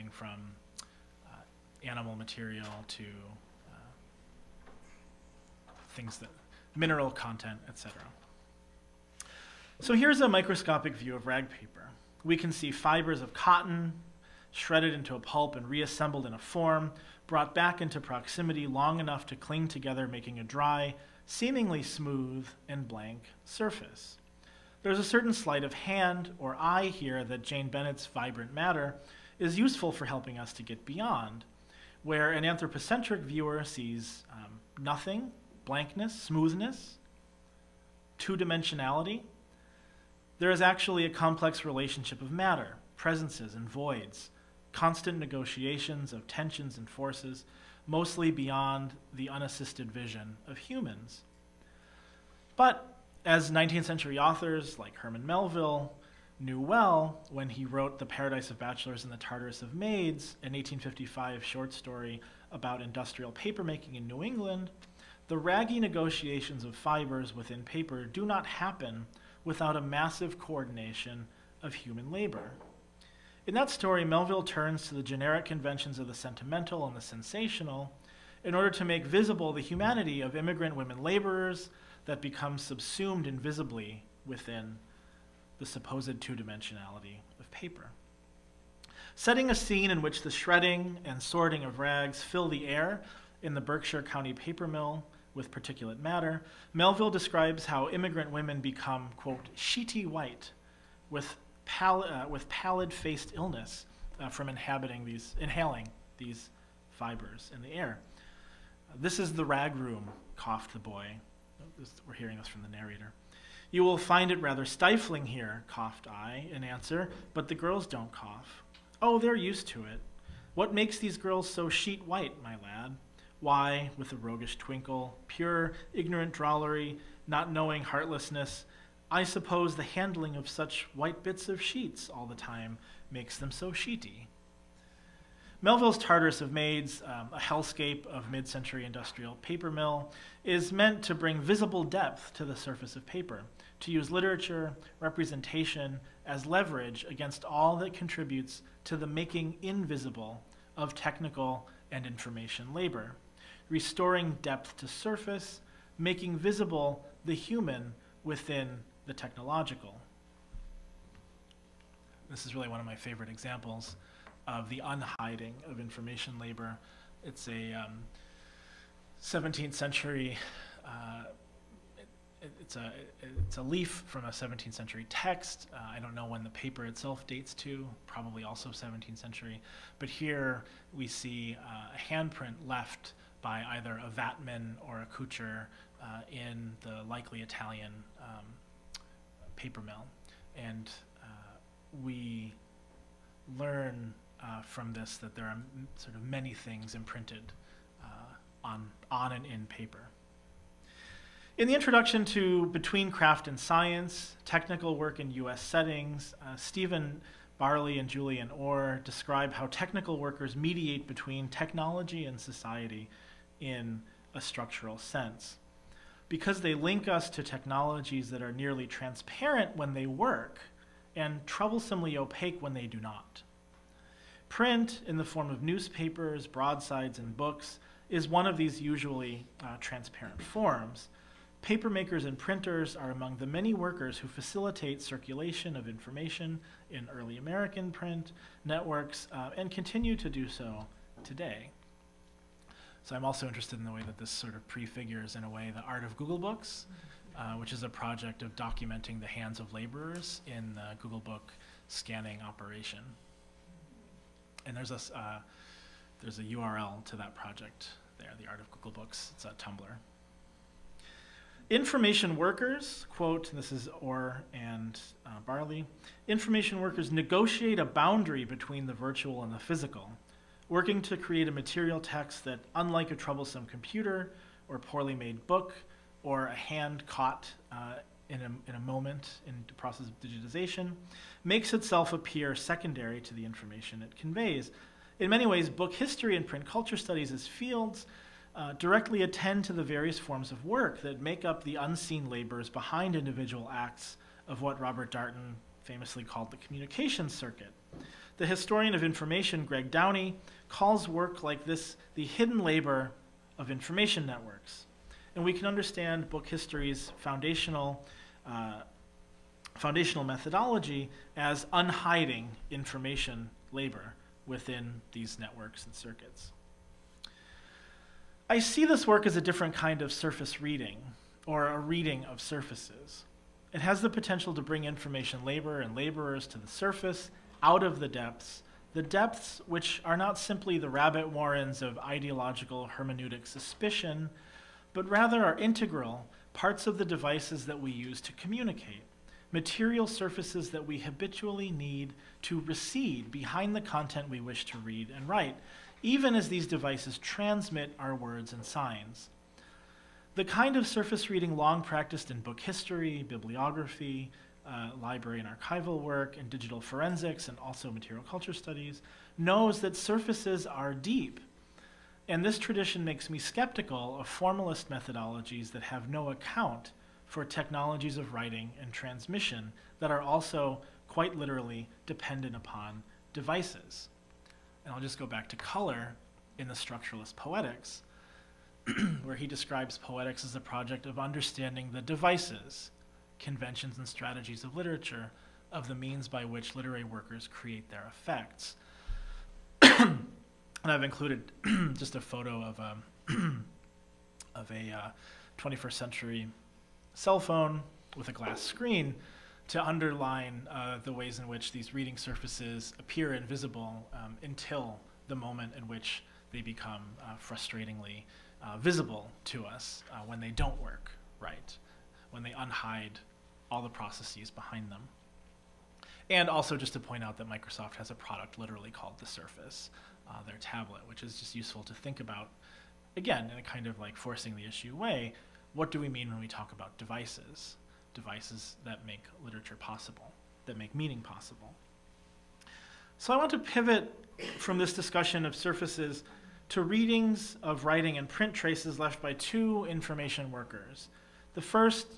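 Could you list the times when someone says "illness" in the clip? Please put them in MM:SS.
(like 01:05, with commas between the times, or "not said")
01:43.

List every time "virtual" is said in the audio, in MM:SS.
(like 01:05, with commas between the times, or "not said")
04:28.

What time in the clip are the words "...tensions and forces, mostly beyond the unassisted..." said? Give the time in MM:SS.
00:46.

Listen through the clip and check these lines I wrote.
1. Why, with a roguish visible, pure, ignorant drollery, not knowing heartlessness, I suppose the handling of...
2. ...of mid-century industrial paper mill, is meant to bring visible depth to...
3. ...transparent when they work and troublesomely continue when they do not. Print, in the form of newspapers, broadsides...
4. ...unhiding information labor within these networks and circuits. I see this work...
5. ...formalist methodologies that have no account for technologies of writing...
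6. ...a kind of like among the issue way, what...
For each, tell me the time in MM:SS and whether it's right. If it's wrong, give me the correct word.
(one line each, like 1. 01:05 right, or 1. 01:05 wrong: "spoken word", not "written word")
1. 02:03 wrong: "twinkle", not "visible"
2. 02:18 right
3. 03:38 wrong: "opaque", not "continue"
4. 05:11 right
5. 06:04 right
6. 07:03 wrong: "forcing", not "among".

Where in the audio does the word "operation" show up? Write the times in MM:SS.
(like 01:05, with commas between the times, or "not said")
04:12.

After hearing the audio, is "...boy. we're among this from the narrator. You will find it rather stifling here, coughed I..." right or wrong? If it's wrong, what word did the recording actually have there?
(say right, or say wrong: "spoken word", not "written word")
wrong: "hearing", not "among".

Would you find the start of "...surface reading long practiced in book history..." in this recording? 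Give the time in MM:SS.
05:50.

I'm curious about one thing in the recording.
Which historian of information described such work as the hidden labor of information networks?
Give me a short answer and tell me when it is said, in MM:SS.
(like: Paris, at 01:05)
Greg Downey, at 04:59.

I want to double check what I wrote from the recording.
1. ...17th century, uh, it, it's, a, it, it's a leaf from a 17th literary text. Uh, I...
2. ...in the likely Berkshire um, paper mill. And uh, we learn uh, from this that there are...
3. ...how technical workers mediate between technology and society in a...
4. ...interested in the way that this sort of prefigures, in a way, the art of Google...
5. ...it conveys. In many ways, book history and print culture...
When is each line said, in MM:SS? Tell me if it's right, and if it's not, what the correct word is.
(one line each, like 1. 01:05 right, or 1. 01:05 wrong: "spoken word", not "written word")
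1. 02:49 wrong: "century", not "literary"
2. 03:06 wrong: "Italian", not "Berkshire"
3. 03:29 right
4. 04:03 right
5. 04:44 right.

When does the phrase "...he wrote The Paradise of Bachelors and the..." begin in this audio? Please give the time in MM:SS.
00:57.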